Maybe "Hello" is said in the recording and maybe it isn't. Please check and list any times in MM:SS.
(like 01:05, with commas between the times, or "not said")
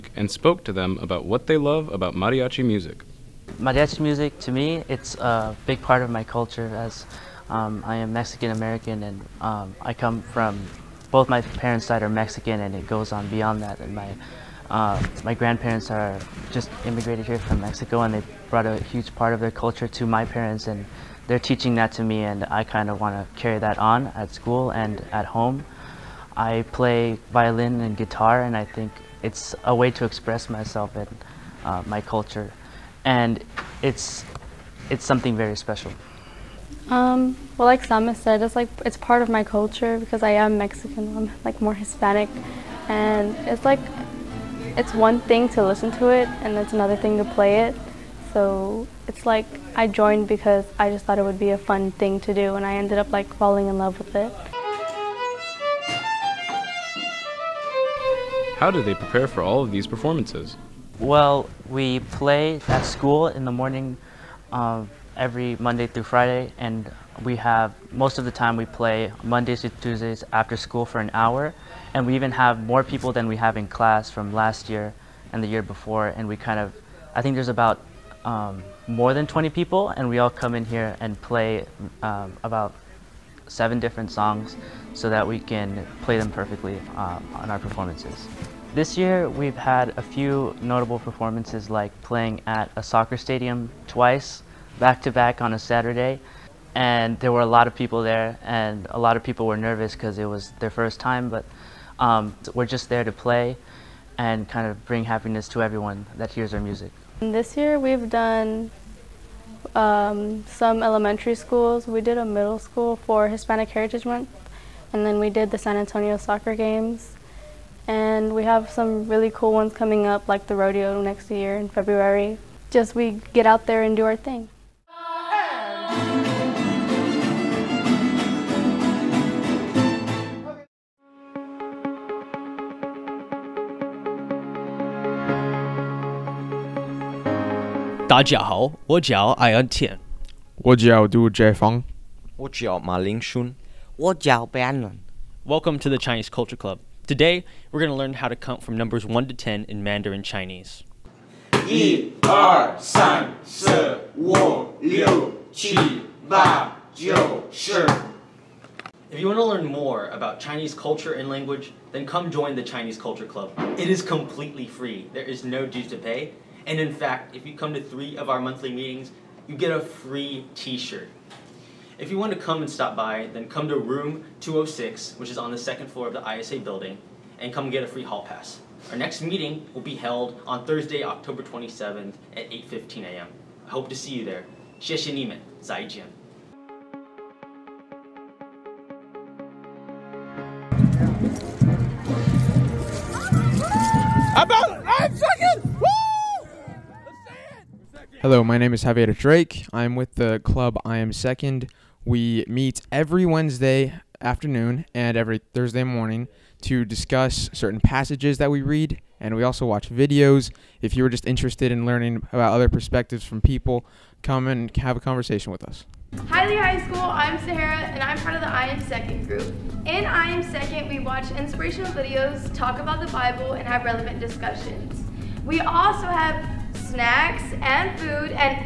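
03:18.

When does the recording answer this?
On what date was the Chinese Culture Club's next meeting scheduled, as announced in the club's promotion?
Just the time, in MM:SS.
03:01.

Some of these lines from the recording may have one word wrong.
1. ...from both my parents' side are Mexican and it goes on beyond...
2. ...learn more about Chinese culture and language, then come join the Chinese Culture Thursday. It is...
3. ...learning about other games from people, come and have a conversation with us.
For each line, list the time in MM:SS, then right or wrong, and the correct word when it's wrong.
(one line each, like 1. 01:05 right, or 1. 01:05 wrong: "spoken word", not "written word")
1. 00:10 right
2. 02:39 wrong: "Club", not "Thursday"
3. 03:31 wrong: "perspectives", not "games".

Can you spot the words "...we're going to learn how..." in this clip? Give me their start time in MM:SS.
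02:27.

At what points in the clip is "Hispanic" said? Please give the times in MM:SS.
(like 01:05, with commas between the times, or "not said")
00:41, 01:53.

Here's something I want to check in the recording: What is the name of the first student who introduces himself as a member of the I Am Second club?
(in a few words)
Javier Drake.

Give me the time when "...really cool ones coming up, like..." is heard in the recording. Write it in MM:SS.
01:59.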